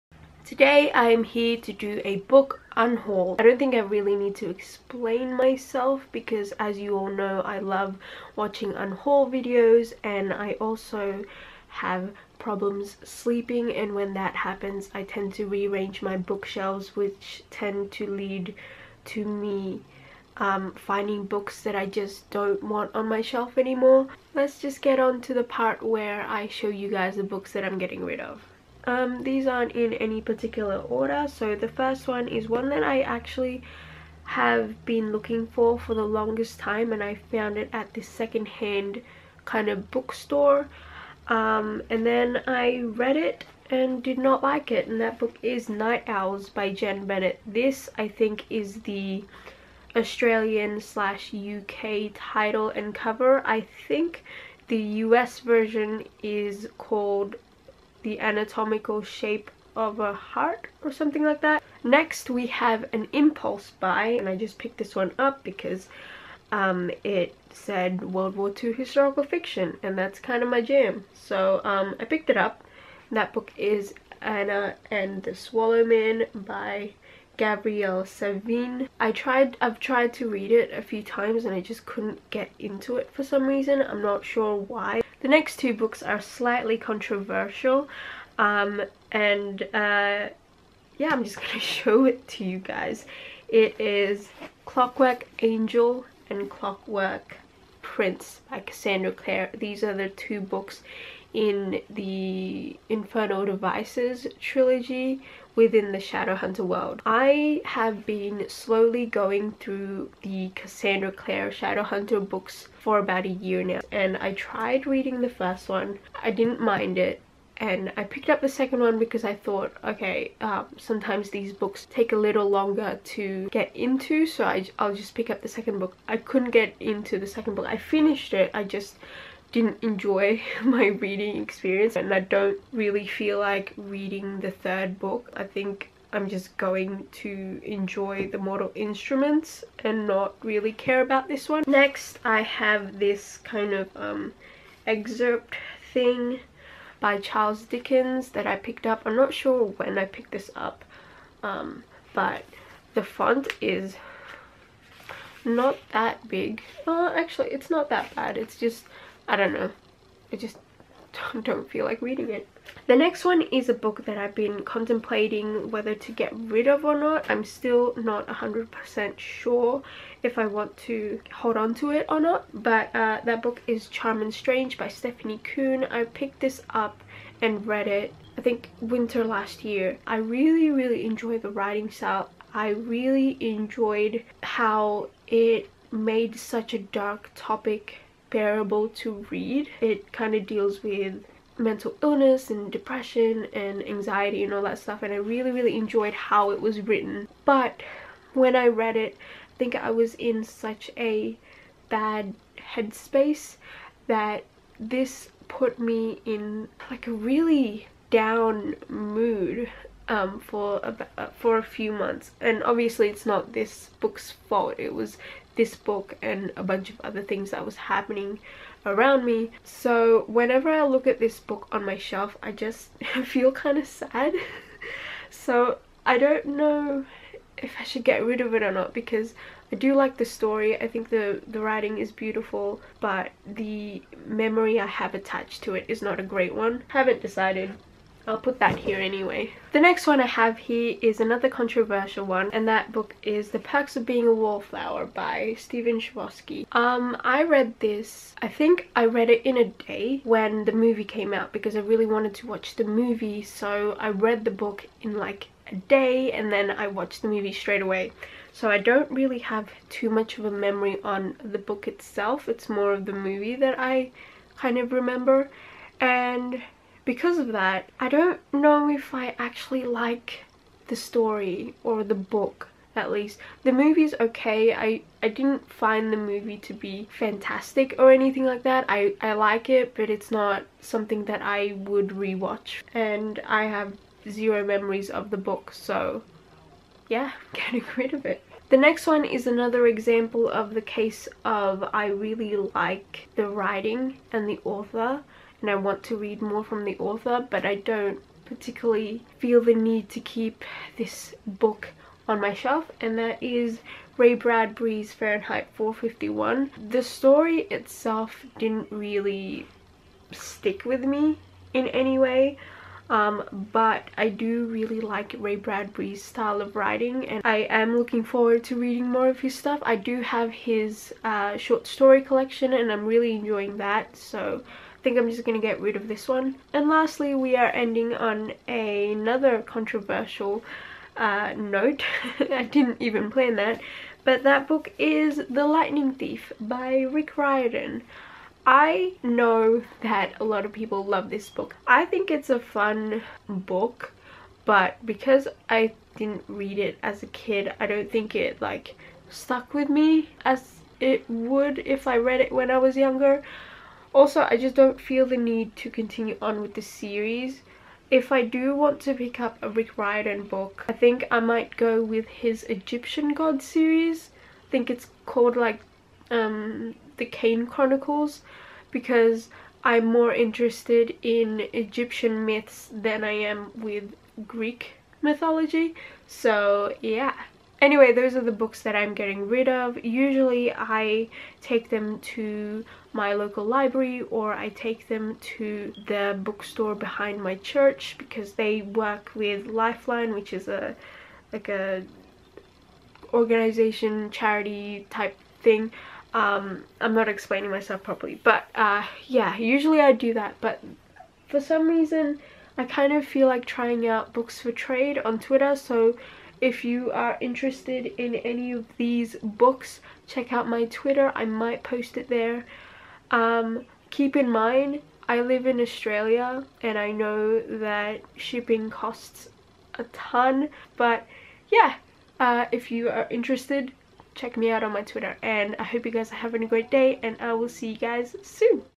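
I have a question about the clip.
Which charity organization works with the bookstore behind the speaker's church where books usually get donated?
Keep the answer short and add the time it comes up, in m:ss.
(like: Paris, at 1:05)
Lifeline, at 6:29.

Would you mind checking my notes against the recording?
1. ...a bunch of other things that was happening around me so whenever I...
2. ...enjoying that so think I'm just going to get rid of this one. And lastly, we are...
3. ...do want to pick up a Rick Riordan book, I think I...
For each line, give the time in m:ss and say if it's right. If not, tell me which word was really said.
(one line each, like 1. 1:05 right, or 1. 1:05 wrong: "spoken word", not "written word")
1. 3:36 right
2. 5:23 right
3. 5:58 right.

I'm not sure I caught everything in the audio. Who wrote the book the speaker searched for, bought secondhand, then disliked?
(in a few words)
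Jenn Bennett.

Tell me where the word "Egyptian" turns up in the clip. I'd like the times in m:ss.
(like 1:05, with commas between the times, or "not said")
6:02, 6:11.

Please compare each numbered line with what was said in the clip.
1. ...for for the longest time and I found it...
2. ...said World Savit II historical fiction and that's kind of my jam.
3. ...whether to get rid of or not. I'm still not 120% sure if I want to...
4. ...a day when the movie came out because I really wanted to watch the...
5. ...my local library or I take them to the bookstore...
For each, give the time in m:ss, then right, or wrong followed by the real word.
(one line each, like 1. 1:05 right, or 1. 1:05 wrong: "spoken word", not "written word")
1. 0:35 right
2. 1:07 wrong: "War", not "Savit"
3. 2:45 wrong: "100", not "120"
4. 4:09 right
5. 6:23 right.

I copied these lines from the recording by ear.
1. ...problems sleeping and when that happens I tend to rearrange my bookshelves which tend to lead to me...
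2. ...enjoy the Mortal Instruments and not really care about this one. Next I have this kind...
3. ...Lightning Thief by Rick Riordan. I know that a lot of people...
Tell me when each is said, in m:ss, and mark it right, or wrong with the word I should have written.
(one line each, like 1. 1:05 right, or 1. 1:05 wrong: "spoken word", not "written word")
1. 0:12 right
2. 2:17 right
3. 5:35 right.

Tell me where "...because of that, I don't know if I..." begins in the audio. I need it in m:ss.
4:27.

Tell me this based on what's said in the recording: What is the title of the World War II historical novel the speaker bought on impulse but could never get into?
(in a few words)
Anna and the Swallowman.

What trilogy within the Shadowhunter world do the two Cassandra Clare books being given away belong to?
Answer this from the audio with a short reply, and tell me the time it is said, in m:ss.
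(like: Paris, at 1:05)
Infernal Devices, at 1:42.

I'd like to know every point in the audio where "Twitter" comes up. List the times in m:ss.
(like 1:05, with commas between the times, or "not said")
6:45, 6:50, 7:05.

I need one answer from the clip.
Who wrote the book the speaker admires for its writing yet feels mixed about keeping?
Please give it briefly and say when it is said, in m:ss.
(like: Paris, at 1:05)
Stephanie Kuehn, at 2:54.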